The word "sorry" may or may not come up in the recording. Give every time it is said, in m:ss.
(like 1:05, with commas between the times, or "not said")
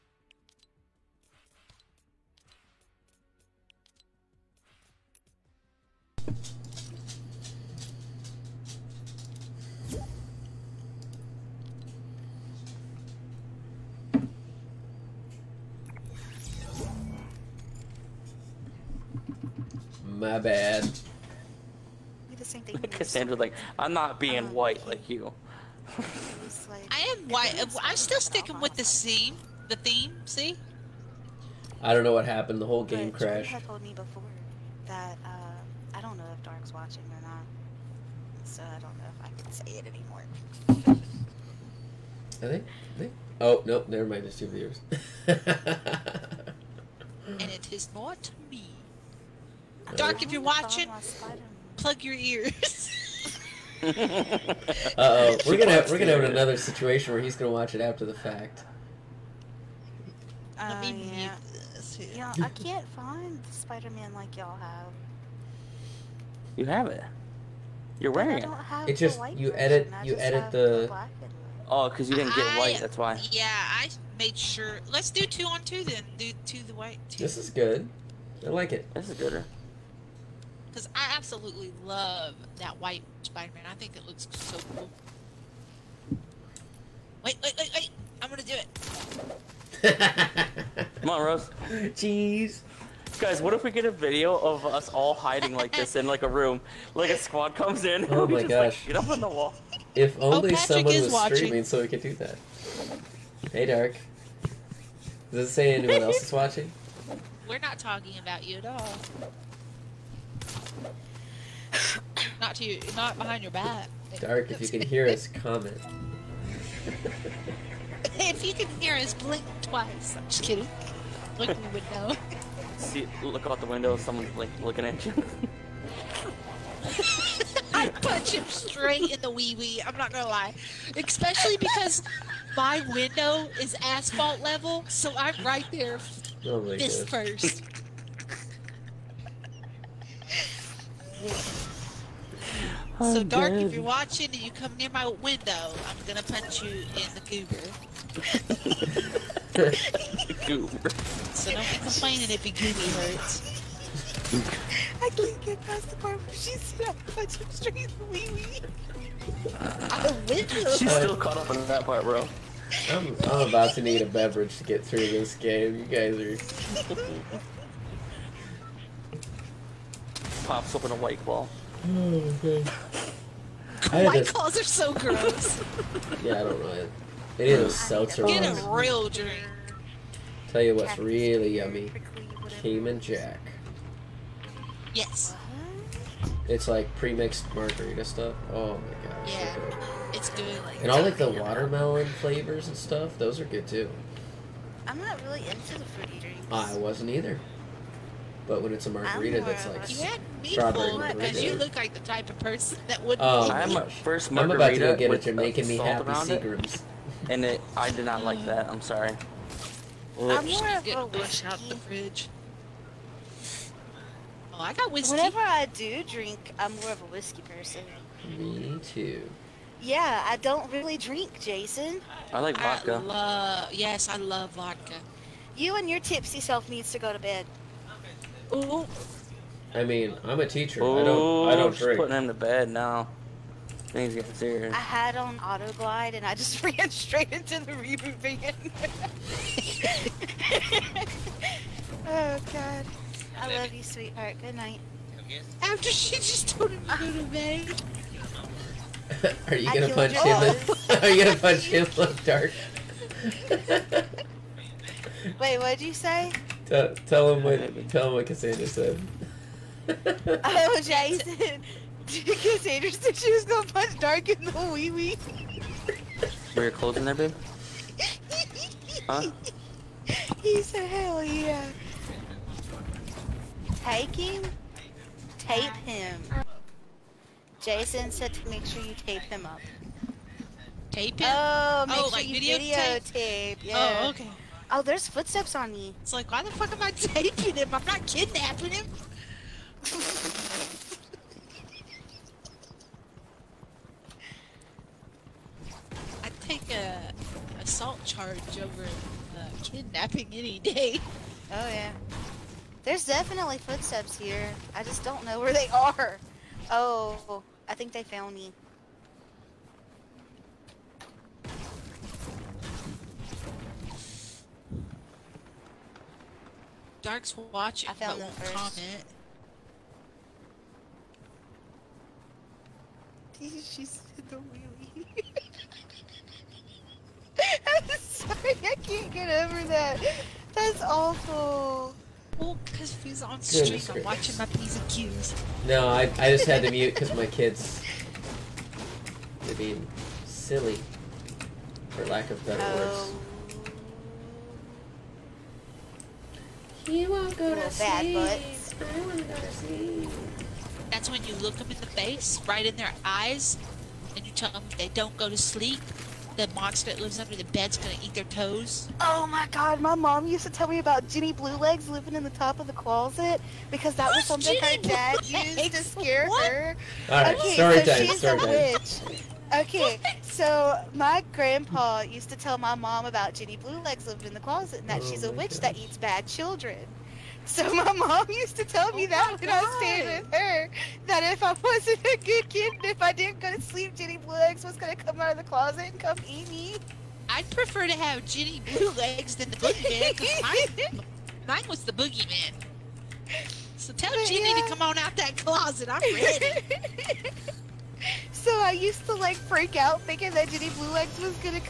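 3:28, 5:27, 6:07.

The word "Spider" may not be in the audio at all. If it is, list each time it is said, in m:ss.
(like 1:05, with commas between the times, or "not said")
1:03, 1:23.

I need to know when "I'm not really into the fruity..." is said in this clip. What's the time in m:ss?
3:14.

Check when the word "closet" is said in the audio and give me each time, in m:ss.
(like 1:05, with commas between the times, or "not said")
6:02, 6:14, 6:25, 6:35.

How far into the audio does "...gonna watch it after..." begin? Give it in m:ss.
0:57.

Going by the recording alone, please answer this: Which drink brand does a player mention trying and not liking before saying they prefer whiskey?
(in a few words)
Seagrams.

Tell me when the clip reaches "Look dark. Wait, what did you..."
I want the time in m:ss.
4:11.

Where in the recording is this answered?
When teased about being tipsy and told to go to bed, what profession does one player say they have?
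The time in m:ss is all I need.
3:50.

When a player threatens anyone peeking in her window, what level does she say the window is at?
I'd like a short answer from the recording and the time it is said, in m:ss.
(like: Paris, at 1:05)
asphalt level, at 2:13.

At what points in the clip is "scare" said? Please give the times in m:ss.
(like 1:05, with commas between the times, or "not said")
6:05.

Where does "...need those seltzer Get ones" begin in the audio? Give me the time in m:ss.
2:57.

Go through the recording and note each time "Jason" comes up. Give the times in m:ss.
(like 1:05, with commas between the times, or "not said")
3:41, 4:20, 4:37.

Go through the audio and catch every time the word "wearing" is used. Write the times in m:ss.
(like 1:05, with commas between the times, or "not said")
1:08.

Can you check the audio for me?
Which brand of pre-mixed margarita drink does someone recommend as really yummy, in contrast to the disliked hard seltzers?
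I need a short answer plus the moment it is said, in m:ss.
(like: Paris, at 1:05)
Cayman Jack, at 3:02.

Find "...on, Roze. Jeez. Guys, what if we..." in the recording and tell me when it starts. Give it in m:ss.
1:31.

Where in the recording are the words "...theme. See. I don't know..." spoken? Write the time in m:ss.
0:29.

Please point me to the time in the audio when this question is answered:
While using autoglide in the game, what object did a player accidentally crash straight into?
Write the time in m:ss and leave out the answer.
3:57.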